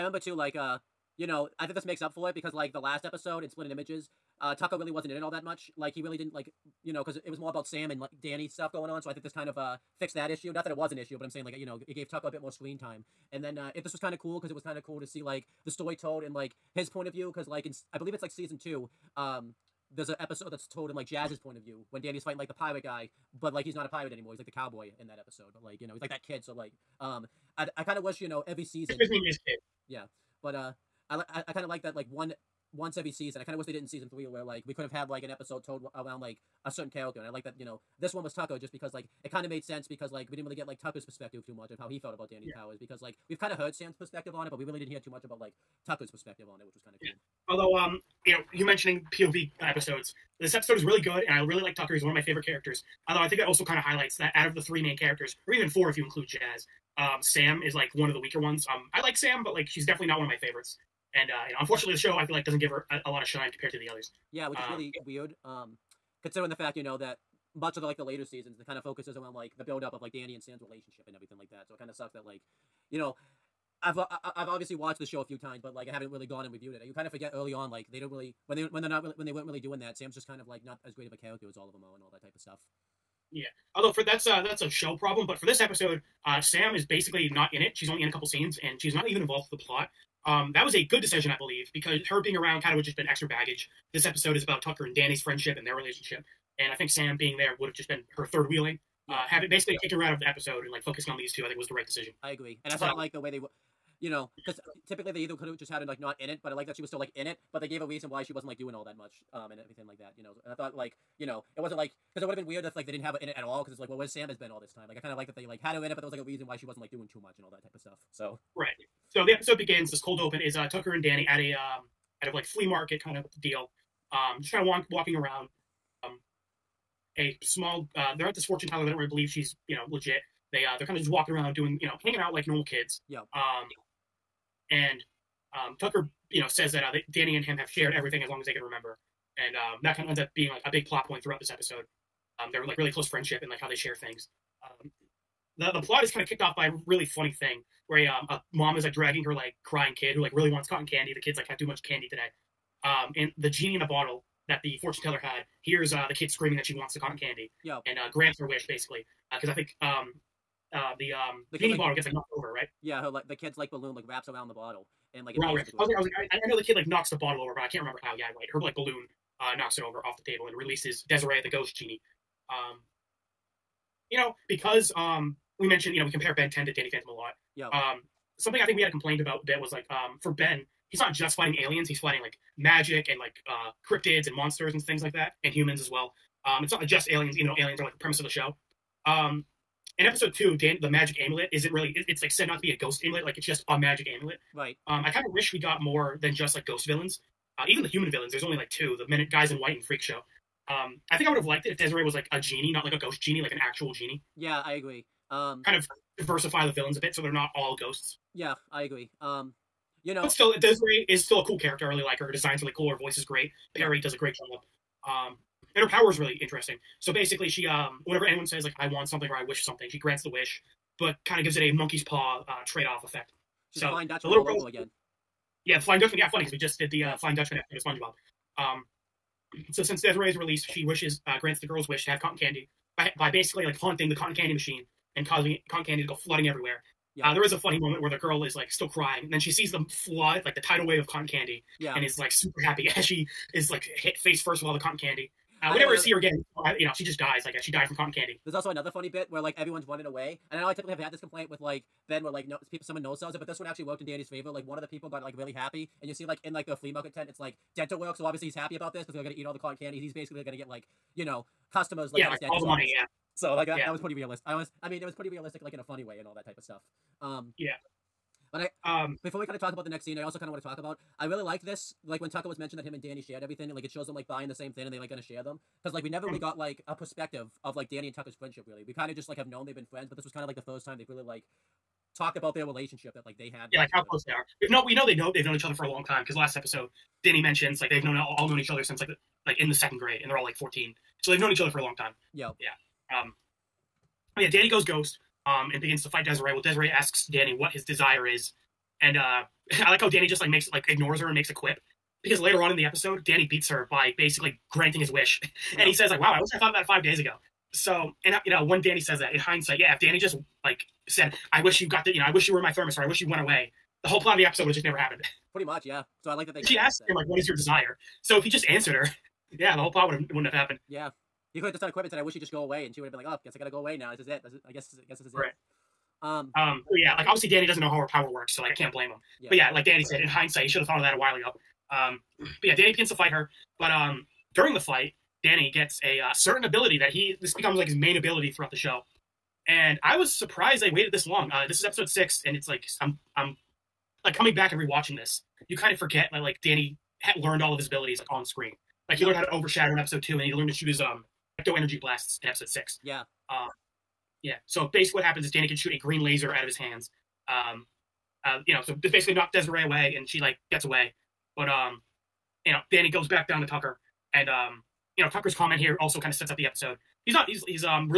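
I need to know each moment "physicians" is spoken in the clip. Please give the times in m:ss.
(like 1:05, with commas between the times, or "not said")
not said.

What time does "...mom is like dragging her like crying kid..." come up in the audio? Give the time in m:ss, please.
2:28.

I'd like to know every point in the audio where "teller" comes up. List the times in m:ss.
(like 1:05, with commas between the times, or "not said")
2:08, 2:35.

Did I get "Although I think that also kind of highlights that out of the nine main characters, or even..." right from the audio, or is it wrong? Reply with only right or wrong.
wrong.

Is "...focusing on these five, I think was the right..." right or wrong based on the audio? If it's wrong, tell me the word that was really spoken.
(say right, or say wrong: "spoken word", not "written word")
wrong: "two", not "five".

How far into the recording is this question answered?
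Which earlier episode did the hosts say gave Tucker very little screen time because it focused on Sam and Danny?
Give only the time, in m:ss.
0:03.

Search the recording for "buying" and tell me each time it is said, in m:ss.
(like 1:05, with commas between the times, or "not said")
4:34.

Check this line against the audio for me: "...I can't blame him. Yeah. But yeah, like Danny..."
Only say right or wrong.
right.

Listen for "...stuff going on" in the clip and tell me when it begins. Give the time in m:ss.
0:08.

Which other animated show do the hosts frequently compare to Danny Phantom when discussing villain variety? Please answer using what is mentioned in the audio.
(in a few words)
Ben 10.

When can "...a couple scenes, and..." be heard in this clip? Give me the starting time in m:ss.
1:28.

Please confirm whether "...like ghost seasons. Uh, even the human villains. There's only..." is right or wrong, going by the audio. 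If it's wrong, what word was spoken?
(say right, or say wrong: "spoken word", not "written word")
wrong: "villains", not "seasons".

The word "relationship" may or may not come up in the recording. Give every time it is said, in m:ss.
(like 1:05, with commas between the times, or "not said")
1:10, 1:35, 4:42.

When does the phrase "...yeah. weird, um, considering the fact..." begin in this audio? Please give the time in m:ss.
1:04.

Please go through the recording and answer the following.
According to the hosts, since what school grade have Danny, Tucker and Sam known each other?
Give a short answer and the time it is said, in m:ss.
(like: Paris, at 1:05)
Second grade, at 4:49.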